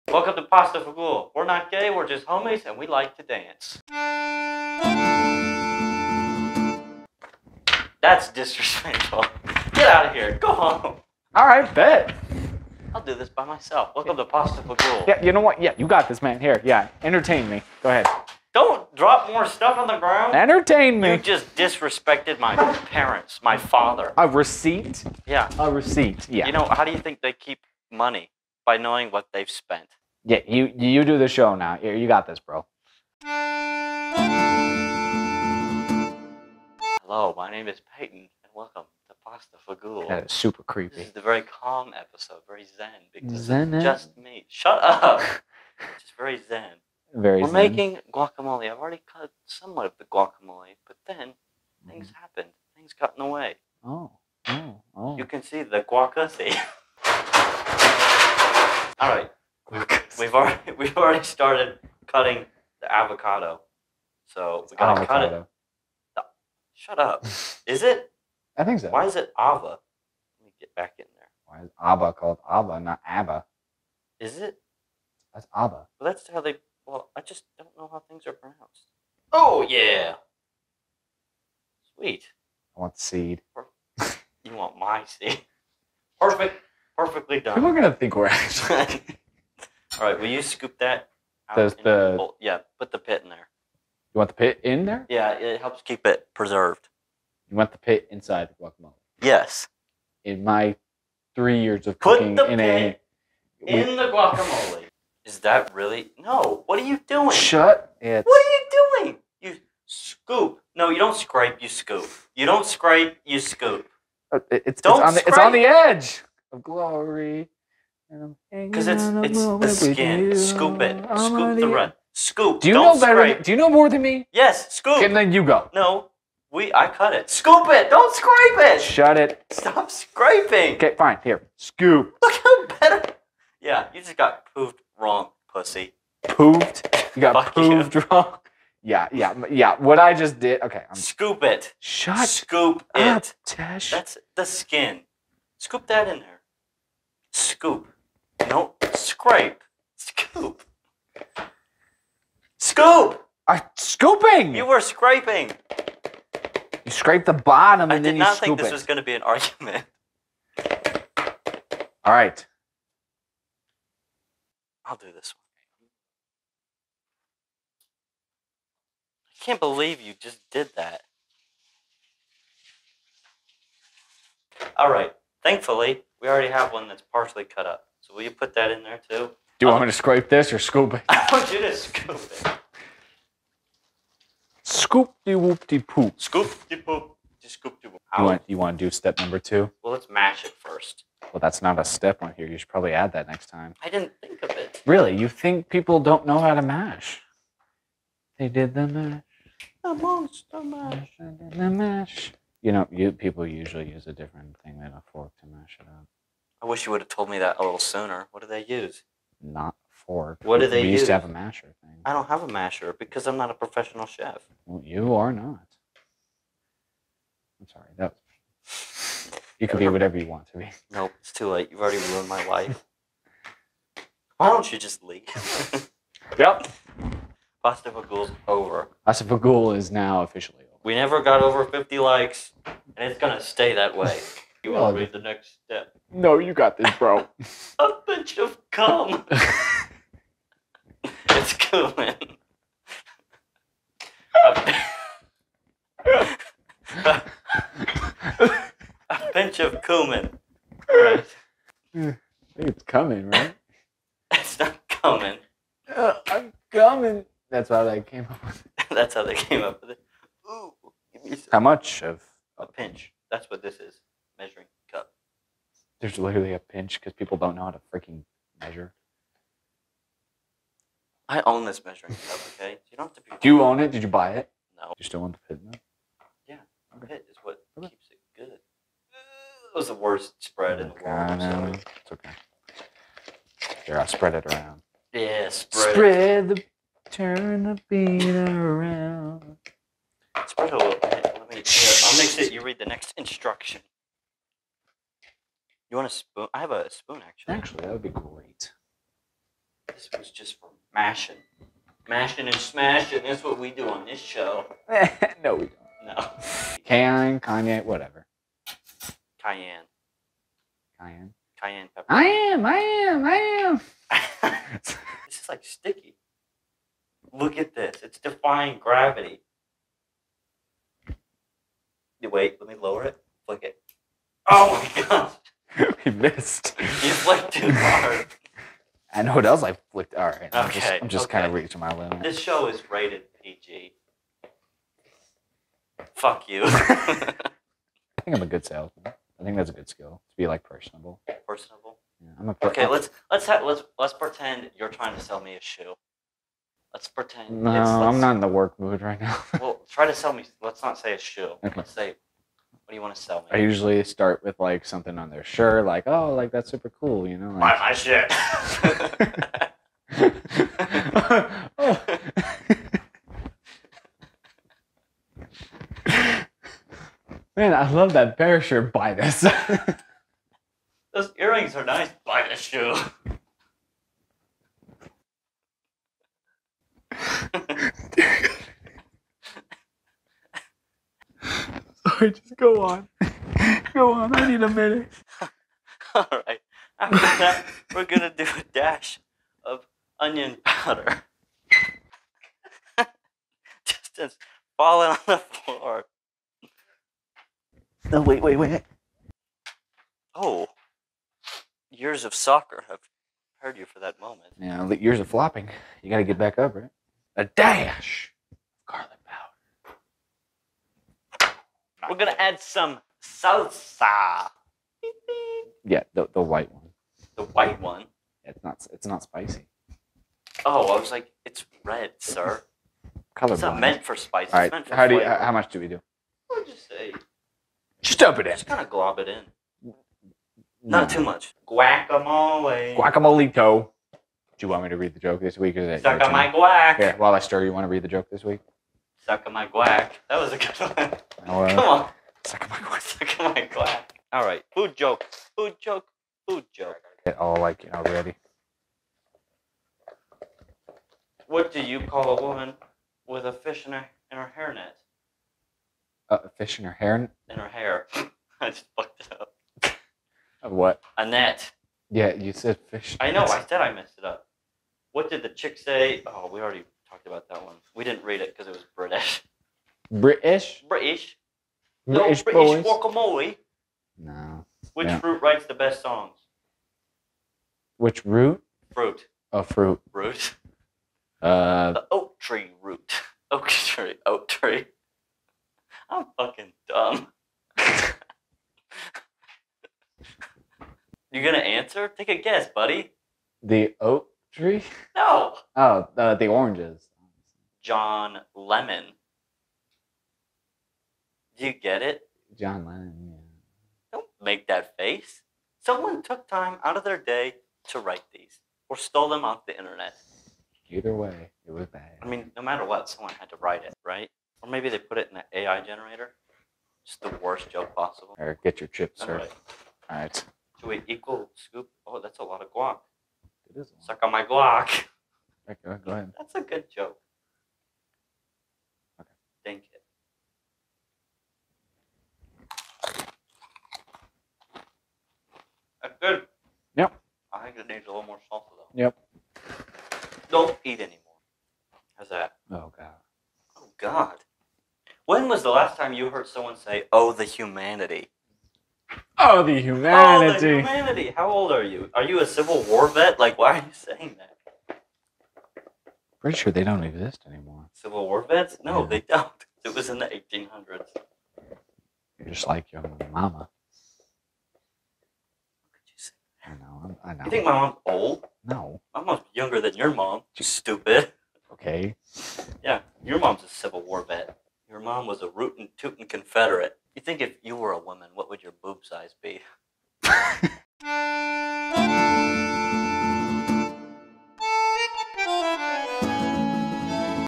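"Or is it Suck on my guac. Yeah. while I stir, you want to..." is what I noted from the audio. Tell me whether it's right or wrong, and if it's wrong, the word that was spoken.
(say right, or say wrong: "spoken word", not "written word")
right.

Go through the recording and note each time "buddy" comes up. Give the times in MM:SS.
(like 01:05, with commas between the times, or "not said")
08:12.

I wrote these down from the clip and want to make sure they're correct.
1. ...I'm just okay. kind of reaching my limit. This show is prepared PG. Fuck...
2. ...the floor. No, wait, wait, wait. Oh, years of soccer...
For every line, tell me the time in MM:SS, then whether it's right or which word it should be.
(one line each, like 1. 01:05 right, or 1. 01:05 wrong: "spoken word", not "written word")
1. 05:31 wrong: "rated", not "prepared"
2. 06:35 right.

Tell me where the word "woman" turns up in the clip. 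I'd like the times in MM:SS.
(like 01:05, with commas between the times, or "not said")
07:32, 09:37.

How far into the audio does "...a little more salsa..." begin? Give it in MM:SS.
08:58.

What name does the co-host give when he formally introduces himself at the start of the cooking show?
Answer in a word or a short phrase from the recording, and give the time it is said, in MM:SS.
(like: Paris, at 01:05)
Peyton, at 00:37.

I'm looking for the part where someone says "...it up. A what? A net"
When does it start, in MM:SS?
07:39.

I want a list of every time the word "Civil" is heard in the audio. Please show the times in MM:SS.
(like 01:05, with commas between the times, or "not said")
09:12, 09:17, 09:33.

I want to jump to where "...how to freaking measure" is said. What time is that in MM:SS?
04:27.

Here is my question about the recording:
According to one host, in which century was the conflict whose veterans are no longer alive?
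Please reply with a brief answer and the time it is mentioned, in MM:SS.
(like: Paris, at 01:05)
1800s, at 09:20.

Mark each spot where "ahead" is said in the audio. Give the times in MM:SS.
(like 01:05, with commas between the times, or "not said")
00:17, 08:46.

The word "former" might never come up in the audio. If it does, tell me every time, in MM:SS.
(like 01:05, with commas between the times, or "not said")
not said.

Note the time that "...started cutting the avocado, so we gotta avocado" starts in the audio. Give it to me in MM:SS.
01:01.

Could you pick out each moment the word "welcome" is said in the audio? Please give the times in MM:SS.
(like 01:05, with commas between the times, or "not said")
00:00, 00:13, 00:38.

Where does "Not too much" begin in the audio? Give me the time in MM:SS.
07:10.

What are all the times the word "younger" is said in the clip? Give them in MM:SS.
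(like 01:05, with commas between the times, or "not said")
09:29.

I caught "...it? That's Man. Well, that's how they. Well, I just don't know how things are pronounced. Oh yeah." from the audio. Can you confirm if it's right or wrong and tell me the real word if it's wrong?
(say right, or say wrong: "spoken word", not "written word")
wrong: "Abba", not "Man".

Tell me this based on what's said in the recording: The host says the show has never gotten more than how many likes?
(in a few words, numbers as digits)
50.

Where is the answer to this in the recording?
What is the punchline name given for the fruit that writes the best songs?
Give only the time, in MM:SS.
08:17.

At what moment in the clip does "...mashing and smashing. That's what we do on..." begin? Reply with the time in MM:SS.
05:02.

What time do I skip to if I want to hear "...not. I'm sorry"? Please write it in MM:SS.
03:35.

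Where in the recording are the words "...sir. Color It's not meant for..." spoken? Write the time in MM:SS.
07:02.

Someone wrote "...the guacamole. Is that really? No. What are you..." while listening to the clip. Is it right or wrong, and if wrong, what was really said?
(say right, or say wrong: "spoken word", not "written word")
right.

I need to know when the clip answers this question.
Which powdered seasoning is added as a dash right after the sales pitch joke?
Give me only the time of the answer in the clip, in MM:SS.
06:30.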